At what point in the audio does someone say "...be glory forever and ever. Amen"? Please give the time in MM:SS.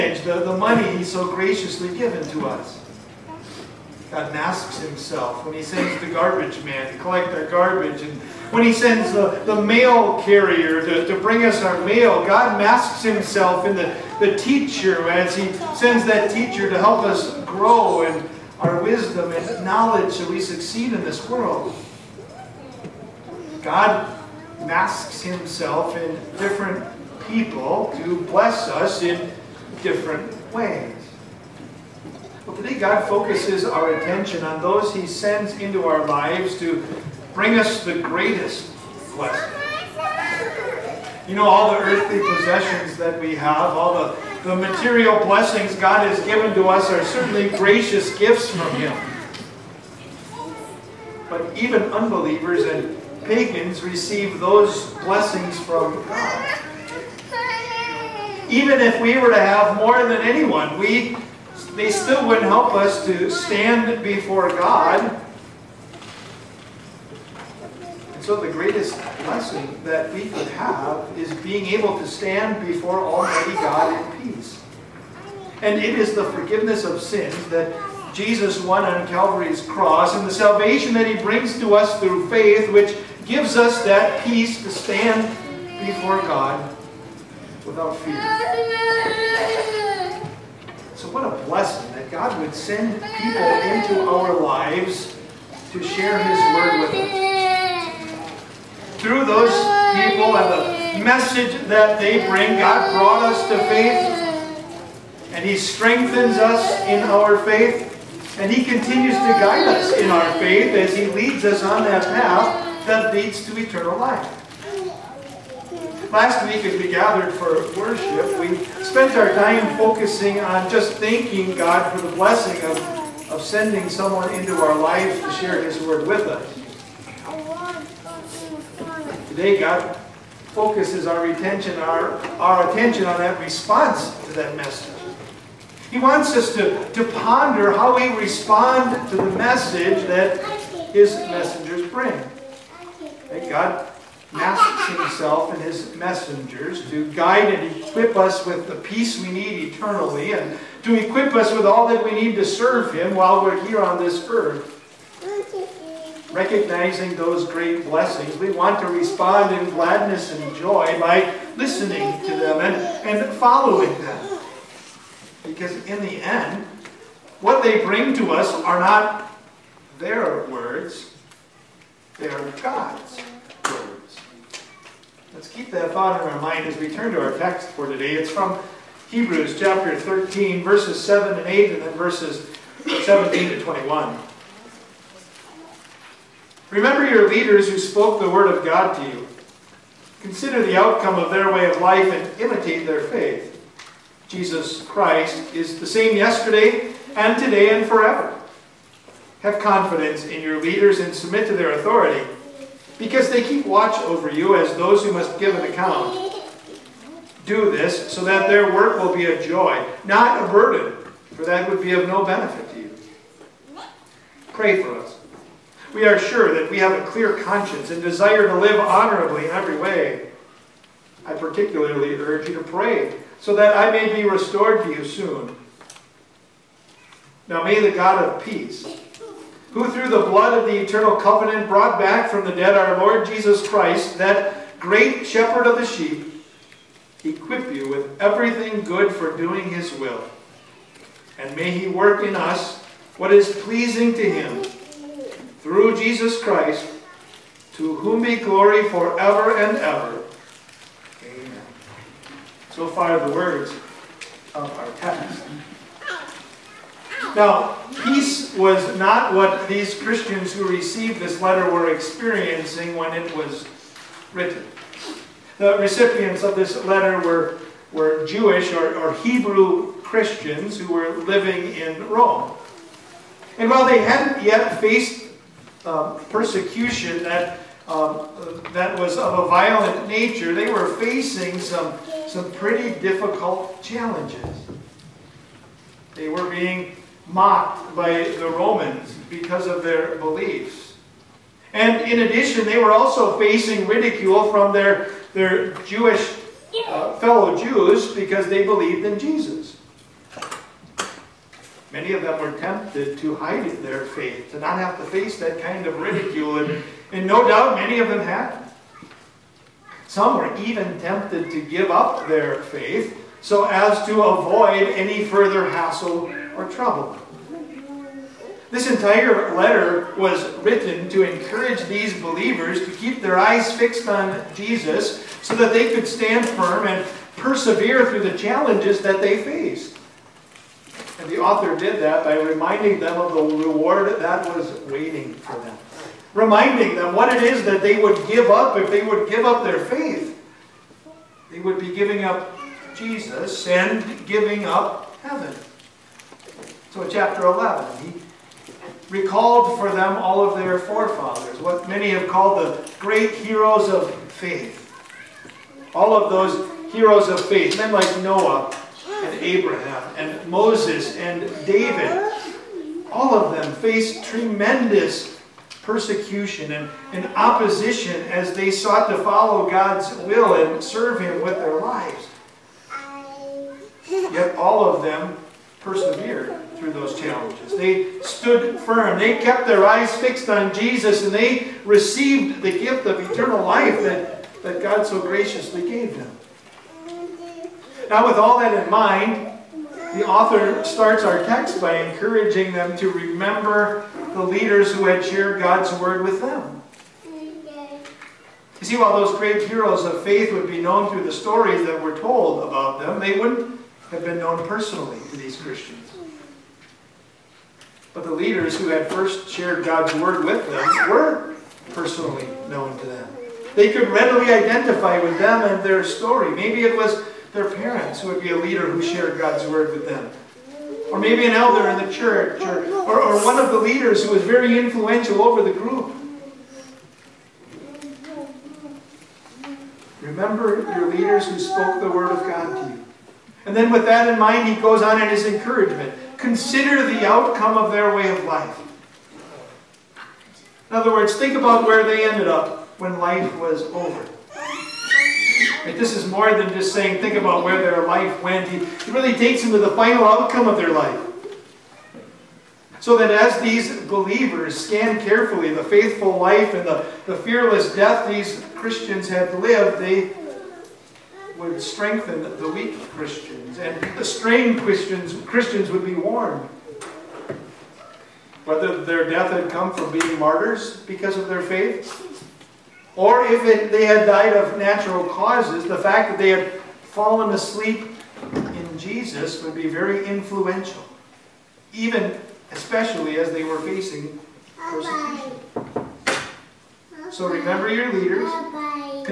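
04:08.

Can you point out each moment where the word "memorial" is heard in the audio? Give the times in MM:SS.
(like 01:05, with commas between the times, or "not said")
not said.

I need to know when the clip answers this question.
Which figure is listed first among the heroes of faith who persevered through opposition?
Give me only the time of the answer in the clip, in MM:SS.
05:58.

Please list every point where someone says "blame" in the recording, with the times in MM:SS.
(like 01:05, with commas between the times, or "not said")
not said.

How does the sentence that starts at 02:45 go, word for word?
Because in the end, what they bring to us are not their words, they are God's words.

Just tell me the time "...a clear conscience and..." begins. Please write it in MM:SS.
03:36.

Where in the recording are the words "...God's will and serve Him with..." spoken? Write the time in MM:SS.
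06:09.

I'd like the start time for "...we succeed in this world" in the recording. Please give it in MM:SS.
00:20.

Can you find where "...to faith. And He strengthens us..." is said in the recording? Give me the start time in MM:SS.
01:43.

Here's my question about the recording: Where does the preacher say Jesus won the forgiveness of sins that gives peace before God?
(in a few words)
Calvary's cross.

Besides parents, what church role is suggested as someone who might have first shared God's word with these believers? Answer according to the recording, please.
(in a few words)
an elder.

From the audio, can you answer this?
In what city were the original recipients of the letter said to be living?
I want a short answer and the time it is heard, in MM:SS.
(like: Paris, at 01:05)
Rome, at 04:32.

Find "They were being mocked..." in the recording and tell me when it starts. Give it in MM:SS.
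04:46.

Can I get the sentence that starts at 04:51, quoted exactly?
And in addition, they were also facing ridicule from their, their Jewish uh, fellow Jews because they believed in Jesus.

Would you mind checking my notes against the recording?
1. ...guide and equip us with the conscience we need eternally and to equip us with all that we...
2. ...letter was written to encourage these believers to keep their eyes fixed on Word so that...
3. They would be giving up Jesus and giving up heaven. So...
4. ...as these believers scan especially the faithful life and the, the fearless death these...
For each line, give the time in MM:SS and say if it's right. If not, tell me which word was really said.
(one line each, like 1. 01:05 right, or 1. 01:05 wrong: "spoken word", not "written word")
1. 02:27 wrong: "peace", not "conscience"
2. 05:19 wrong: "Jesus", not "Word"
3. 05:41 right
4. 07:33 wrong: "carefully", not "especially".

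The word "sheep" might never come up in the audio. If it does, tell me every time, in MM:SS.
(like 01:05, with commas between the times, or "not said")
03:55.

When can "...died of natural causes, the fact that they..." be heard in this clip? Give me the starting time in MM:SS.
07:54.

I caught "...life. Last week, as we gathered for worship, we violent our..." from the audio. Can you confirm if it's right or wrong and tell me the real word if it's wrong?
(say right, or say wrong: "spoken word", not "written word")
wrong: "spent", not "violent".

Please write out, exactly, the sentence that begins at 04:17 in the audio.
Now, peace was not what these Christians who received this letter were experiencing when it was written.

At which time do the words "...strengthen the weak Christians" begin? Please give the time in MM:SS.
07:41.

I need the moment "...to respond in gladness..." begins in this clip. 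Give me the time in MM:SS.
02:38.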